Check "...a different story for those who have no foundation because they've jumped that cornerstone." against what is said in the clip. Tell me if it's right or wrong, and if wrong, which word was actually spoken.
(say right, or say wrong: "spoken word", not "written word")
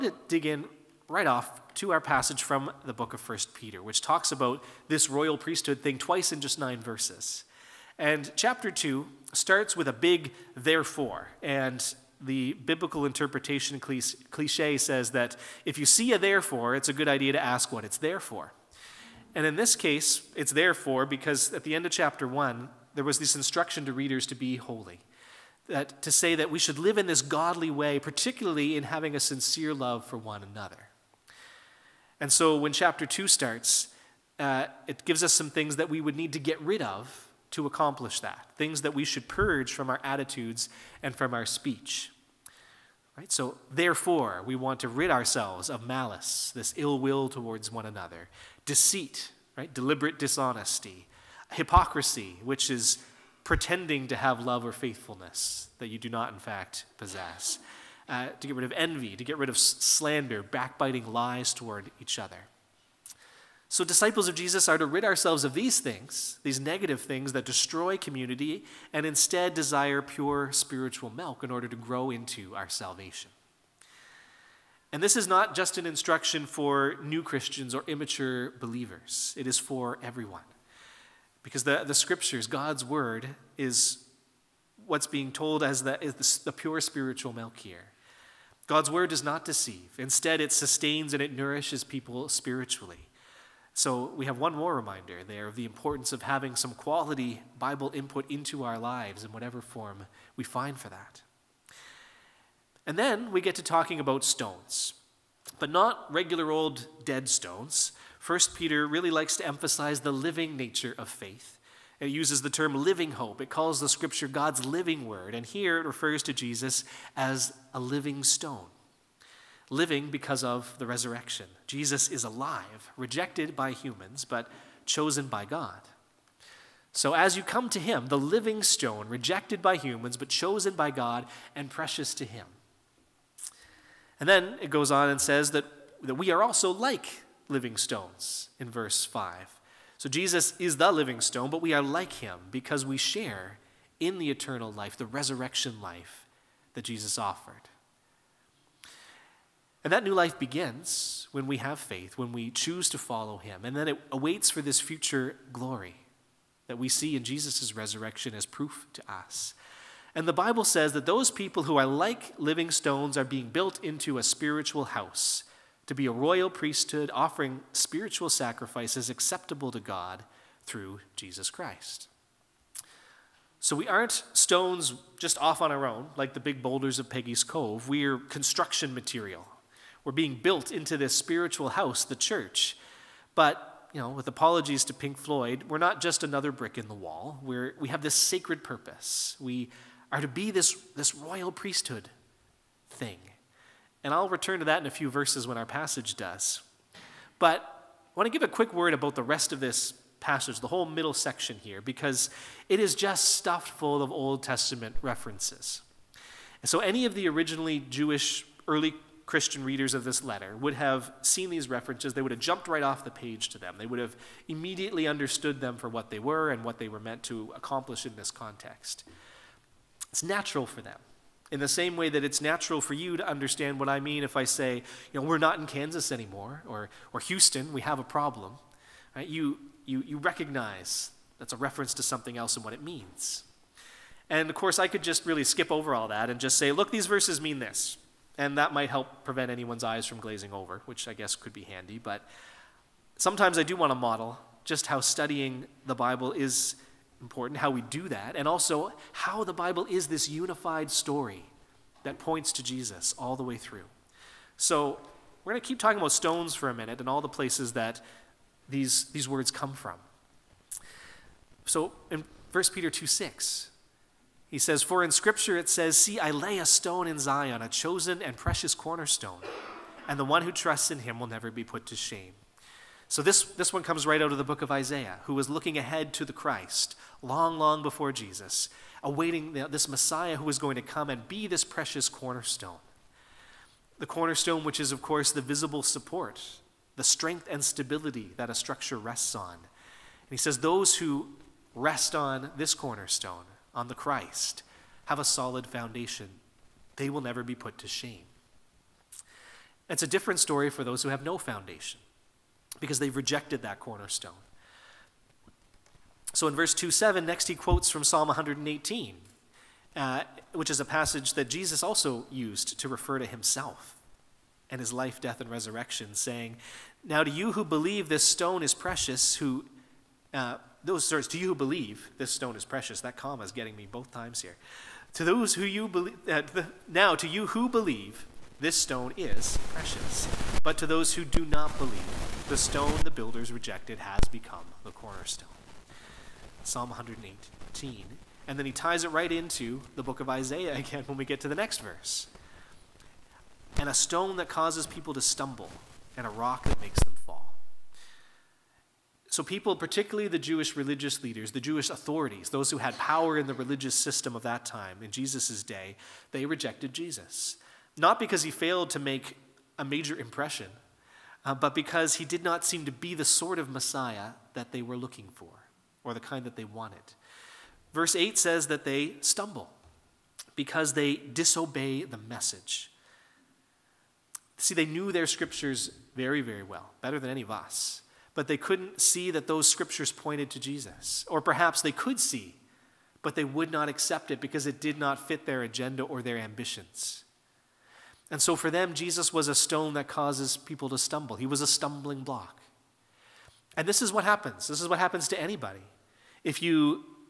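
wrong: "rejected", not "jumped".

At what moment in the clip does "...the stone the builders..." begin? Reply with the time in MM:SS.
05:32.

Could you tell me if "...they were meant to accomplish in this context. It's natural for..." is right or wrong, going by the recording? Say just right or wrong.
right.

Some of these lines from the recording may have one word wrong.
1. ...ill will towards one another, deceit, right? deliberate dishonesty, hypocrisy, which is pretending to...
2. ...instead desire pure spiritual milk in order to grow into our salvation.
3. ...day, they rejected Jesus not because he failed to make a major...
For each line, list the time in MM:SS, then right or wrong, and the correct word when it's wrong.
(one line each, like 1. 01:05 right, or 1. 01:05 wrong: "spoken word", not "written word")
1. 00:46 right
2. 01:09 right
3. 05:55 right.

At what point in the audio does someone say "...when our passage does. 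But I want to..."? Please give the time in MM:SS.
03:15.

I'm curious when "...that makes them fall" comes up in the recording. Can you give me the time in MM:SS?
05:46.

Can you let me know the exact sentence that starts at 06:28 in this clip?
And so for them, Jesus was a stone that causes people to stumble.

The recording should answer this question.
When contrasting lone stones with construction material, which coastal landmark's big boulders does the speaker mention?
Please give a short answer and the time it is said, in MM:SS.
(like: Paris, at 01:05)
Peggy's Cove, at 02:57.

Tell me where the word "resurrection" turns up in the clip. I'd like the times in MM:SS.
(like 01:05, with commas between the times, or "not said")
02:00, 02:25, 02:37, 05:15.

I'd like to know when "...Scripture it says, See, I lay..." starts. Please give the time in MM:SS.
04:25.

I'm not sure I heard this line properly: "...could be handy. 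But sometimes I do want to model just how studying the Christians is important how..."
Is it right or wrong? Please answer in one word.
wrong.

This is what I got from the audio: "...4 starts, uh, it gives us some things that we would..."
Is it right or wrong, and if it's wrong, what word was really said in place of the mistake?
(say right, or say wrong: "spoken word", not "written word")
wrong: "2", not "4".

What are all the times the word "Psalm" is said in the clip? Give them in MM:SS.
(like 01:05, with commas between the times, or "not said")
05:08, 05:36.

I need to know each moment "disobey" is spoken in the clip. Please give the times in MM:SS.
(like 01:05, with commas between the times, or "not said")
06:11.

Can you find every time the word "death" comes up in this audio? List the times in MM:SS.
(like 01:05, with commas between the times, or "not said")
05:15.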